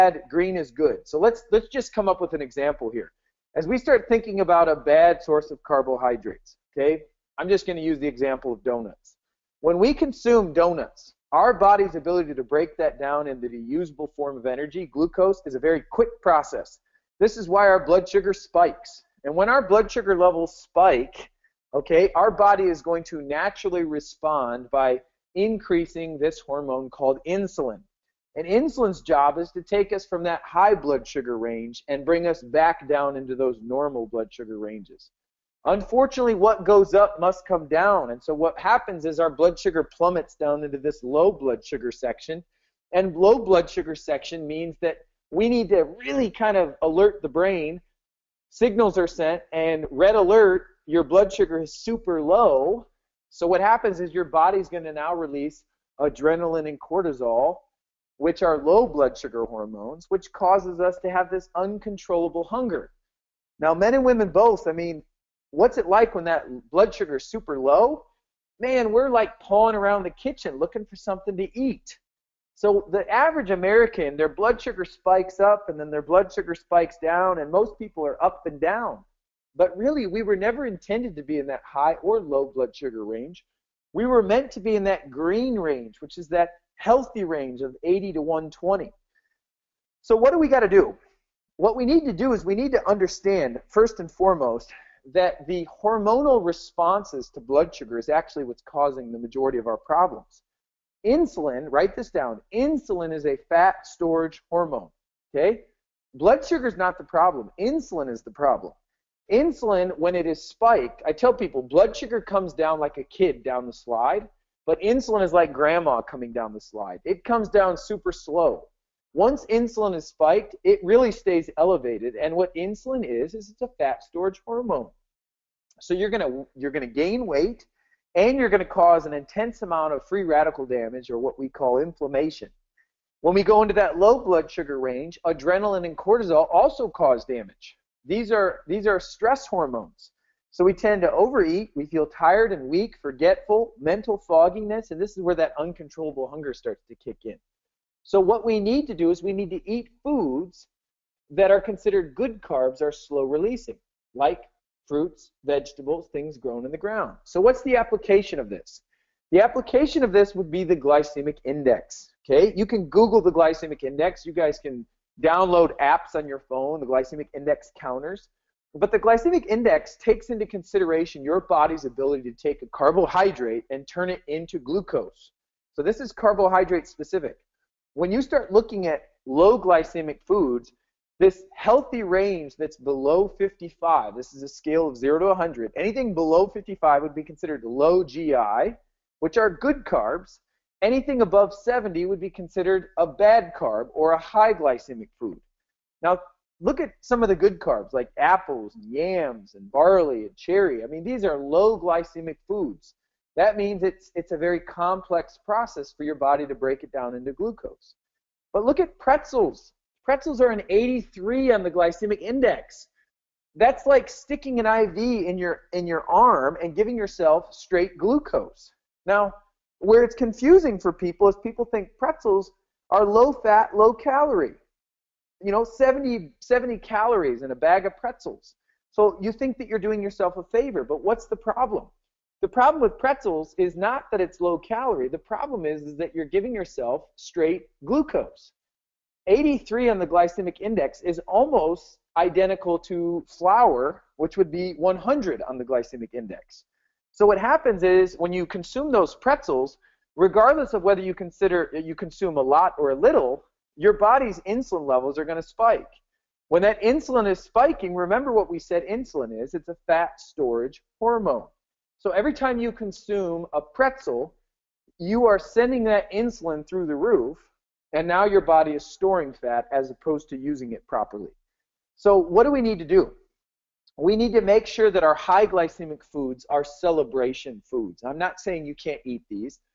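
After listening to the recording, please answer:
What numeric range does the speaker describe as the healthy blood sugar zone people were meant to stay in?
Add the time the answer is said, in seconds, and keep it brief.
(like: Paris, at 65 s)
80 to 120, at 87 s.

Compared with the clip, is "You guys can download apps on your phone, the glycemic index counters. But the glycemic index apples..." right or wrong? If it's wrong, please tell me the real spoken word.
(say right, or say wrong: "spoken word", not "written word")
wrong: "takes", not "apples".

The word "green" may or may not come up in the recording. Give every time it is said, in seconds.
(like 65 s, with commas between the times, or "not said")
0 s, 85 s.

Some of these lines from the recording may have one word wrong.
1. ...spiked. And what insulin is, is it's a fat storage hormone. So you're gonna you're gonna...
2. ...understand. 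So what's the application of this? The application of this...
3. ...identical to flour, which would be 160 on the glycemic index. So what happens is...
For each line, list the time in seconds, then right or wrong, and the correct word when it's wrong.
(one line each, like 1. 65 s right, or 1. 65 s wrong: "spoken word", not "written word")
1. 121 s wrong: "elevated", not "spiked"
2. 156 s wrong: "ground", not "understand"
3. 242 s wrong: "100", not "160".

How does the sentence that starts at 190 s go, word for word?
Anything above 70 would be considered a bad carb or a high glycemic food.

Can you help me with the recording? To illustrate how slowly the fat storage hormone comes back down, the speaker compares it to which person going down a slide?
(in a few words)
Grandma.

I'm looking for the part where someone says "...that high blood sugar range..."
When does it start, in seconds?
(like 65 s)
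30 s.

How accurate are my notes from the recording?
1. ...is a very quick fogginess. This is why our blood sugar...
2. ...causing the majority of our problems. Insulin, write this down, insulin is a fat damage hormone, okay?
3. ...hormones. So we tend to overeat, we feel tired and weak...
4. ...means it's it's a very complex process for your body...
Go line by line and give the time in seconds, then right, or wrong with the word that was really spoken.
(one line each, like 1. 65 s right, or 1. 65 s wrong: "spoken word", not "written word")
1. 15 s wrong: "process", not "fogginess"
2. 98 s wrong: "storage", not "damage"
3. 139 s right
4. 203 s right.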